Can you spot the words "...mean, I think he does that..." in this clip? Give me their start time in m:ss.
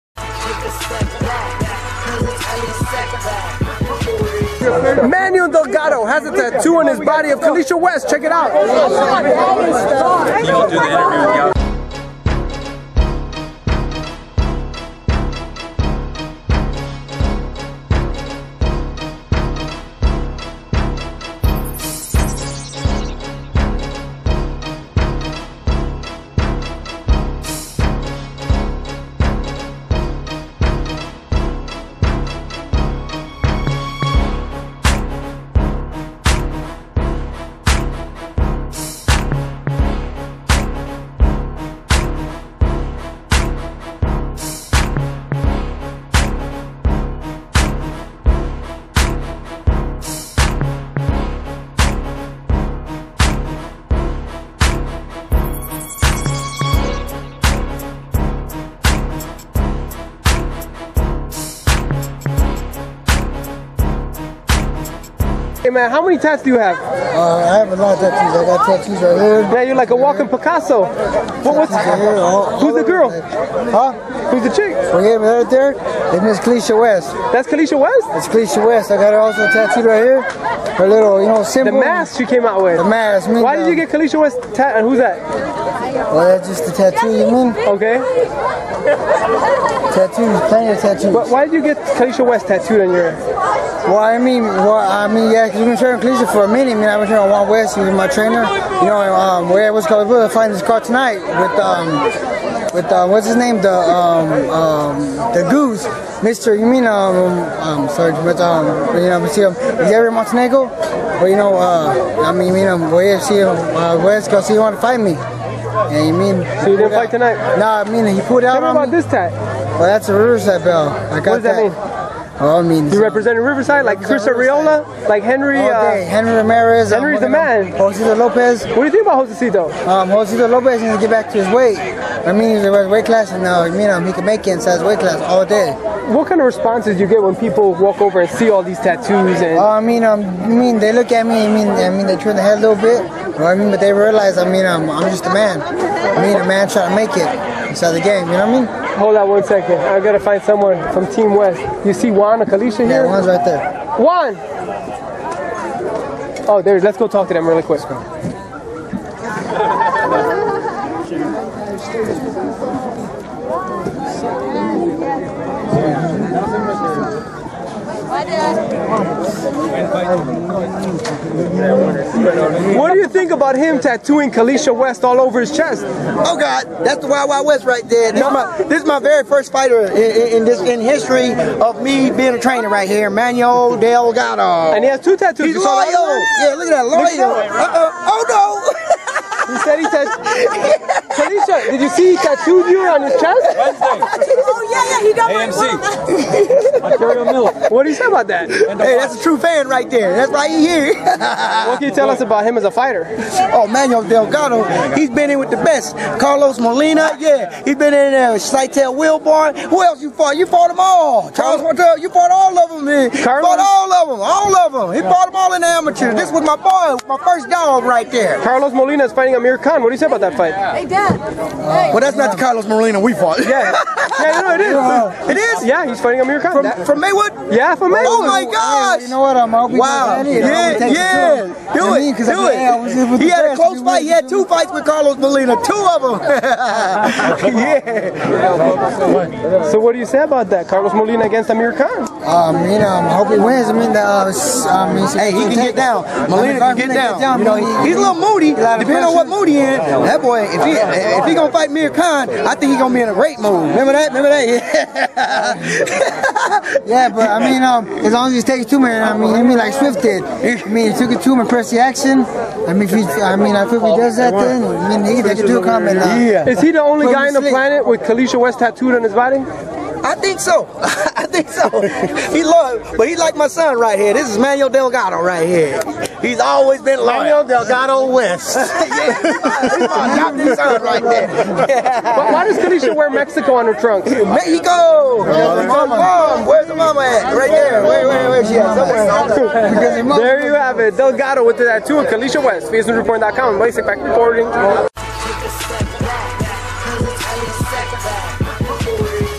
4:23.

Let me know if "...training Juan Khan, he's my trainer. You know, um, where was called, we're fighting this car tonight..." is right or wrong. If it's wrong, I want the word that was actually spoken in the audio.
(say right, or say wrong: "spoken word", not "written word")
wrong: "West", not "Khan".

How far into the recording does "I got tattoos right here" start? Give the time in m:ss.
1:08.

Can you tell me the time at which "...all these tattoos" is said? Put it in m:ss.
2:18.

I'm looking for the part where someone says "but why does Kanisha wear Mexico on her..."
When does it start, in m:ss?
4:41.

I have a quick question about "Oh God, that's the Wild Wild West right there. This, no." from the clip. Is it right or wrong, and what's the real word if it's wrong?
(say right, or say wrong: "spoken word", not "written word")
right.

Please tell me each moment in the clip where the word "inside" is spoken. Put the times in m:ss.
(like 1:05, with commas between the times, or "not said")
2:14, 2:27.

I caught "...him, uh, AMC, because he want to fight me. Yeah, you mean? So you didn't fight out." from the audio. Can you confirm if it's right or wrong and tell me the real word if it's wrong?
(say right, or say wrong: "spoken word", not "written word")
wrong: "West", not "AMC".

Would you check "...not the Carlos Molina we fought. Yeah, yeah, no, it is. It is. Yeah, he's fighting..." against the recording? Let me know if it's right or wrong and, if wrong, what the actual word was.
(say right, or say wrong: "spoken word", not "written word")
right.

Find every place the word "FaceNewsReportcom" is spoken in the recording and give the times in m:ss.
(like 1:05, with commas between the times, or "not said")
4:52.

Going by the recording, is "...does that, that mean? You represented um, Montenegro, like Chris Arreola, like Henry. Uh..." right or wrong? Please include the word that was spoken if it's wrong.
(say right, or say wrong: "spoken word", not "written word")
wrong: "Riverside", not "Montenegro".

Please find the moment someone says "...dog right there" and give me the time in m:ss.
3:37.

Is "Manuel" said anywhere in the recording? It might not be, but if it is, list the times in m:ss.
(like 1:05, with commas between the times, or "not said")
0:05, 3:03, 3:23, 4:34.